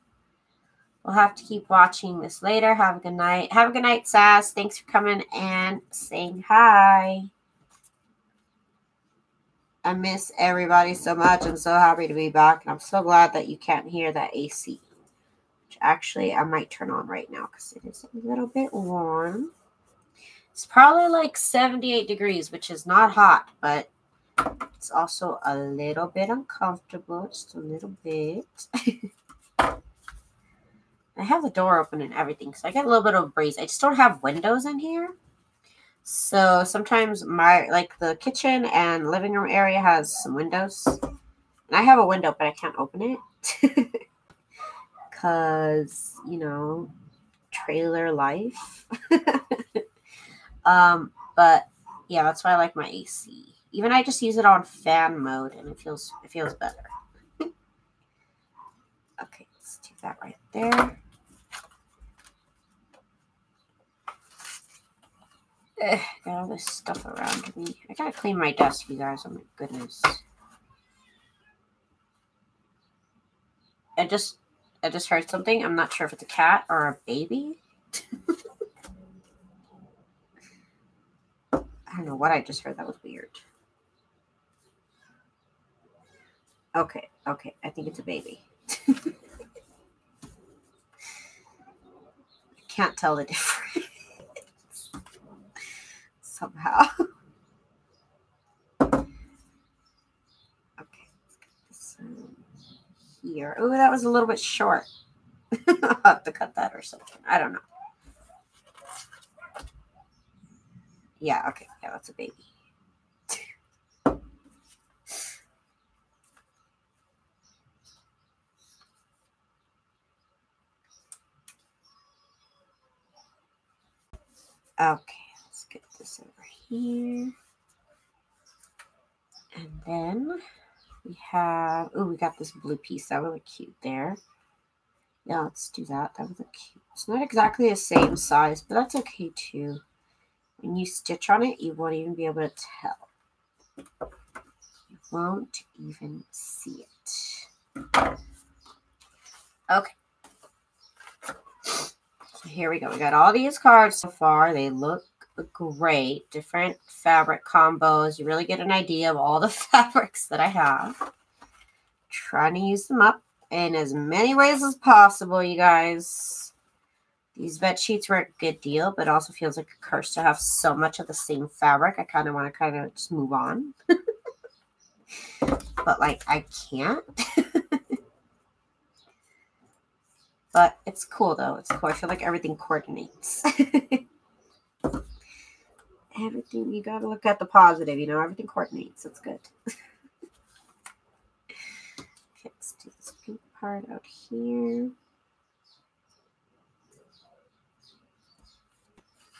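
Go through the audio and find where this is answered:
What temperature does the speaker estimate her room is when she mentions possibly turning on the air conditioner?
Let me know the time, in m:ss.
0:21.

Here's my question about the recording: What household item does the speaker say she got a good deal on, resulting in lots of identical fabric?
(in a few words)
bed sheets.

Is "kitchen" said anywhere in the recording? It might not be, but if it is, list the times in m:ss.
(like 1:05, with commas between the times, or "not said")
0:38.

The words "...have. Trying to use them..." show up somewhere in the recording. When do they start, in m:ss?
2:40.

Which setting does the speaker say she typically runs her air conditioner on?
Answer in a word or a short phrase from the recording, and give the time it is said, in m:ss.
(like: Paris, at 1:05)
fan mode, at 0:54.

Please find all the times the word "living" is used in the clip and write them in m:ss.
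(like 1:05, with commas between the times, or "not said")
0:39.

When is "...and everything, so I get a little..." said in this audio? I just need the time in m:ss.
0:32.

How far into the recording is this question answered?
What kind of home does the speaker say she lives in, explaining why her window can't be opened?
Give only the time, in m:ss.
0:47.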